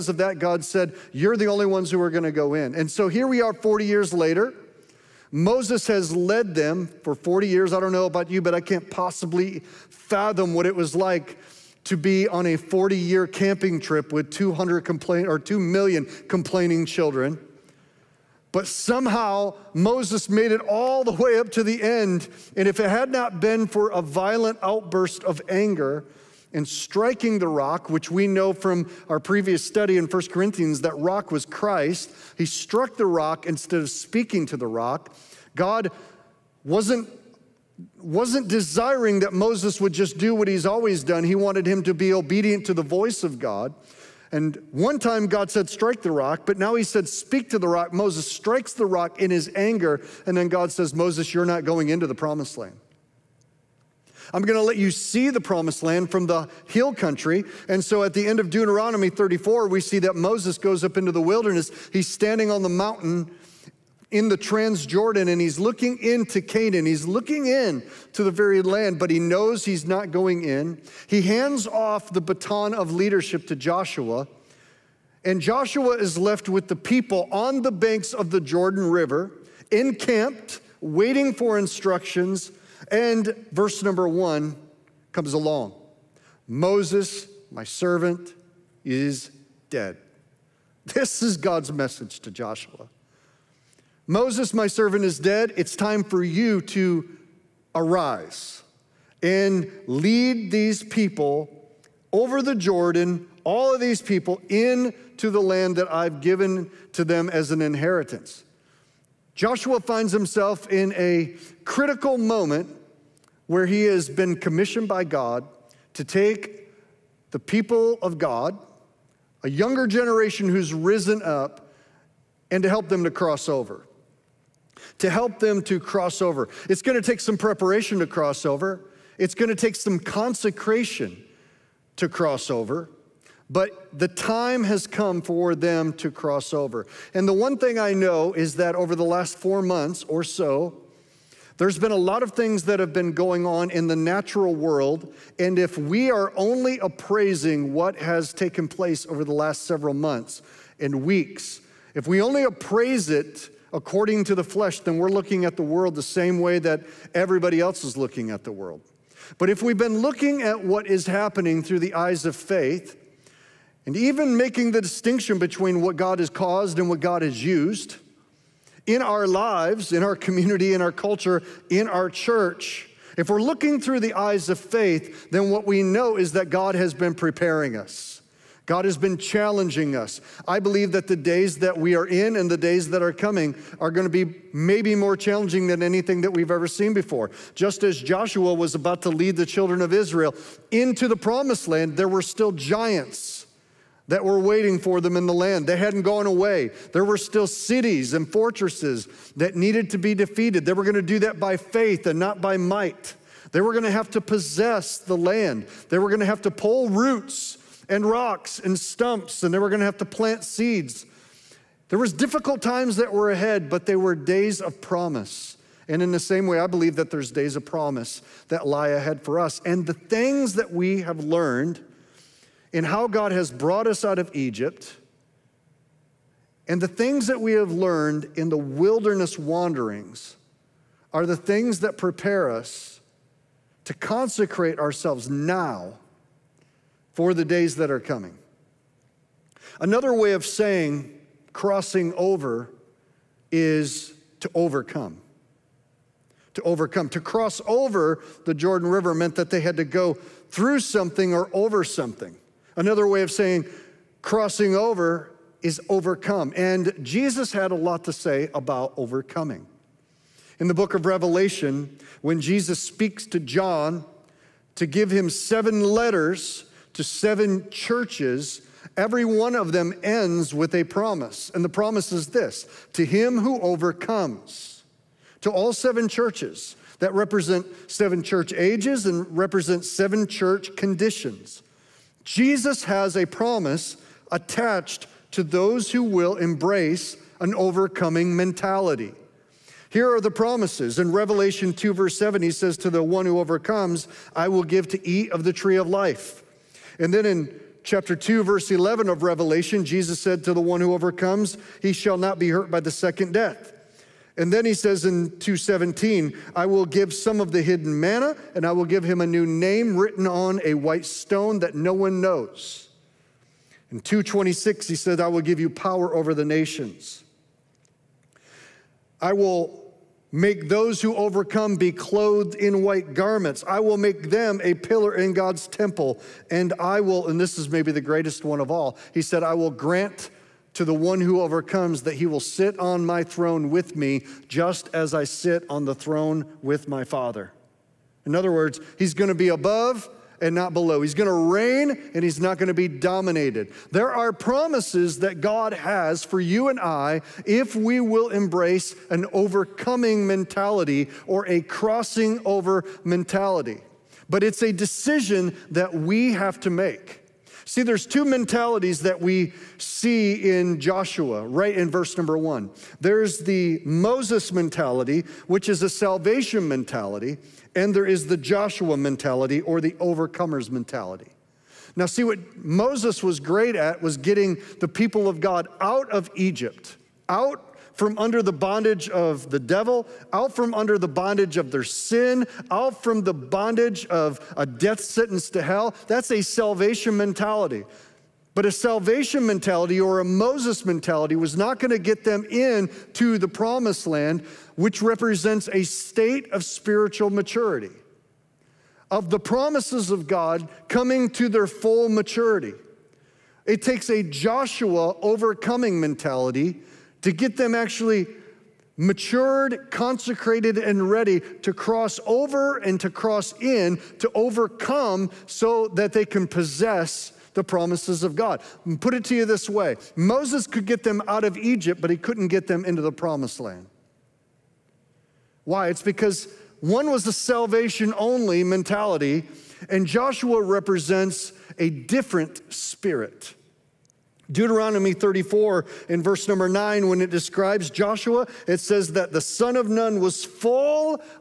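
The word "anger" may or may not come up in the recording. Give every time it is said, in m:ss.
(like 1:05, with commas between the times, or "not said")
0:25, 0:49.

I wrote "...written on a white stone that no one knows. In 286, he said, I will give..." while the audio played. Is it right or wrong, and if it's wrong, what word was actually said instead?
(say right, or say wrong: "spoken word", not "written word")
wrong: "226", not "286".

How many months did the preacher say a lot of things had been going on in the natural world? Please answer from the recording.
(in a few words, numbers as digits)
4.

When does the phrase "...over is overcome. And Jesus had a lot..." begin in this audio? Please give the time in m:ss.
4:14.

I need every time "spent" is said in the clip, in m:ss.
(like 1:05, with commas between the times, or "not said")
not said.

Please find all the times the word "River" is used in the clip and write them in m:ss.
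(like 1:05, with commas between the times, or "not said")
1:18, 4:08.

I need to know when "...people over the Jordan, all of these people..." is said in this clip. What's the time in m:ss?
1:40.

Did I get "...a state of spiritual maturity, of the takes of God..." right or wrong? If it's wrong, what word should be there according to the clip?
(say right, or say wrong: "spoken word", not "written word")
wrong: "promises", not "takes".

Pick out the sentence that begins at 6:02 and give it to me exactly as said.
There's the Moses mentality, which is a salvation mentality, and there is the Joshua mentality or the overcomer's mentality.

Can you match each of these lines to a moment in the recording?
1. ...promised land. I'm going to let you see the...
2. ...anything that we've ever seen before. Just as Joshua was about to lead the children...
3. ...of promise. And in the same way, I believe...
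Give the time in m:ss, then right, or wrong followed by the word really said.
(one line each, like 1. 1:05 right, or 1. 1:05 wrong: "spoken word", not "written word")
1. 0:52 right
2. 3:05 right
3. 3:34 right.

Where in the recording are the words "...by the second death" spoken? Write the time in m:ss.
5:02.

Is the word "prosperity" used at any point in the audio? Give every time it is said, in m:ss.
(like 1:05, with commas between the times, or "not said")
not said.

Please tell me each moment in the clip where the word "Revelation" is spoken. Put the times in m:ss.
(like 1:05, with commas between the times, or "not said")
4:21, 4:51, 4:59.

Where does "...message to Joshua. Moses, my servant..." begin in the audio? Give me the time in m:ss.
1:31.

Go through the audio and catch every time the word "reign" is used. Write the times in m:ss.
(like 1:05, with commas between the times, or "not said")
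5:41.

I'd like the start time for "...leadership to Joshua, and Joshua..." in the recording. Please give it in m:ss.
1:12.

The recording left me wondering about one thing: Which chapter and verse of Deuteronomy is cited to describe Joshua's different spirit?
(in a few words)
Deuteronomy 34:9.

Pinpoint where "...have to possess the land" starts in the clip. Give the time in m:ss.
3:23.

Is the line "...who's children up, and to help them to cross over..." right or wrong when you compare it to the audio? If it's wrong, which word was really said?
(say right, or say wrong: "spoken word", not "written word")
wrong: "risen", not "children".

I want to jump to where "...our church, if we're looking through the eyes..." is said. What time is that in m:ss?
2:51.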